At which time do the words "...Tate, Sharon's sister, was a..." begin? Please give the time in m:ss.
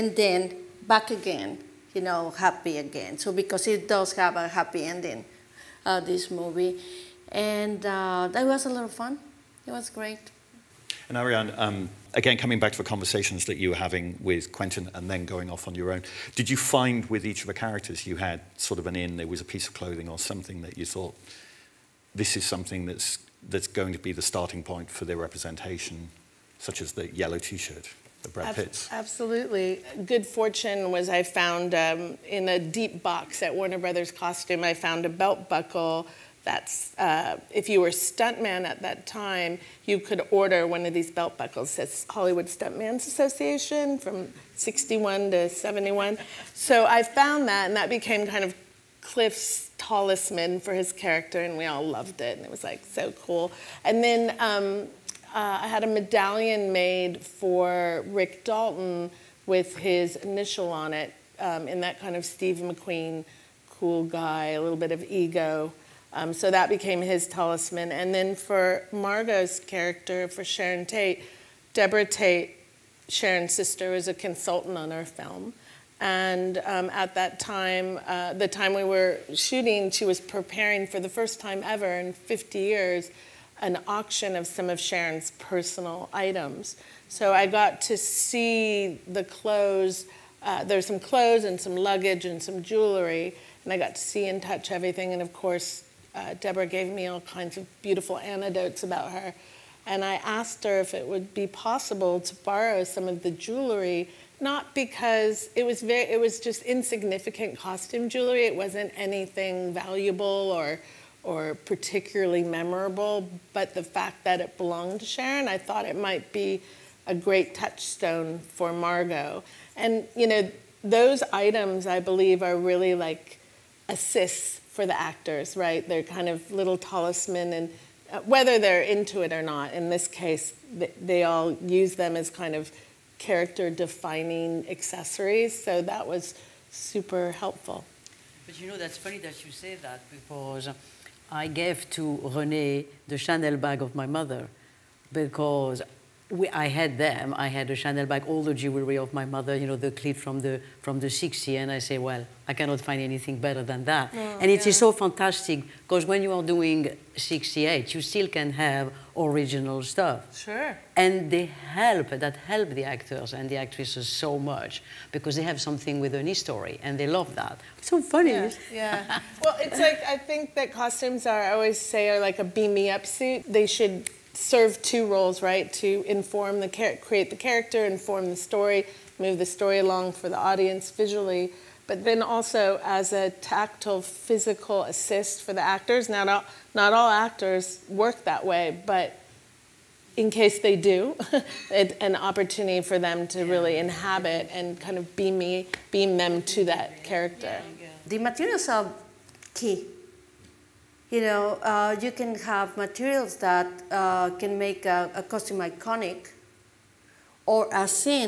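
1:12.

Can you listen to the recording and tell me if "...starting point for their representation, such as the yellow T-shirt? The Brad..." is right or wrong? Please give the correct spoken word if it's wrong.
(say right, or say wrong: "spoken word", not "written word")
right.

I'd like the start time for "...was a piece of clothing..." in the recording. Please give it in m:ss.
0:19.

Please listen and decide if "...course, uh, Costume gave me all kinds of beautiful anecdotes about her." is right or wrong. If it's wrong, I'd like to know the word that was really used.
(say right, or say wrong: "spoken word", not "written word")
wrong: "Debra", not "Costume".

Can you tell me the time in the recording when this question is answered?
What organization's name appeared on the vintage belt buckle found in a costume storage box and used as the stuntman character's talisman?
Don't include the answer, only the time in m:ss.
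0:42.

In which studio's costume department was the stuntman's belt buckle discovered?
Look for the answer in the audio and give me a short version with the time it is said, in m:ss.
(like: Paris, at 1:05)
Warner Brothers, at 0:33.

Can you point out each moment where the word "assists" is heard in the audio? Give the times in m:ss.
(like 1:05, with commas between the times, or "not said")
2:03, 3:04.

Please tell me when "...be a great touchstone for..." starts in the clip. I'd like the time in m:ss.
1:56.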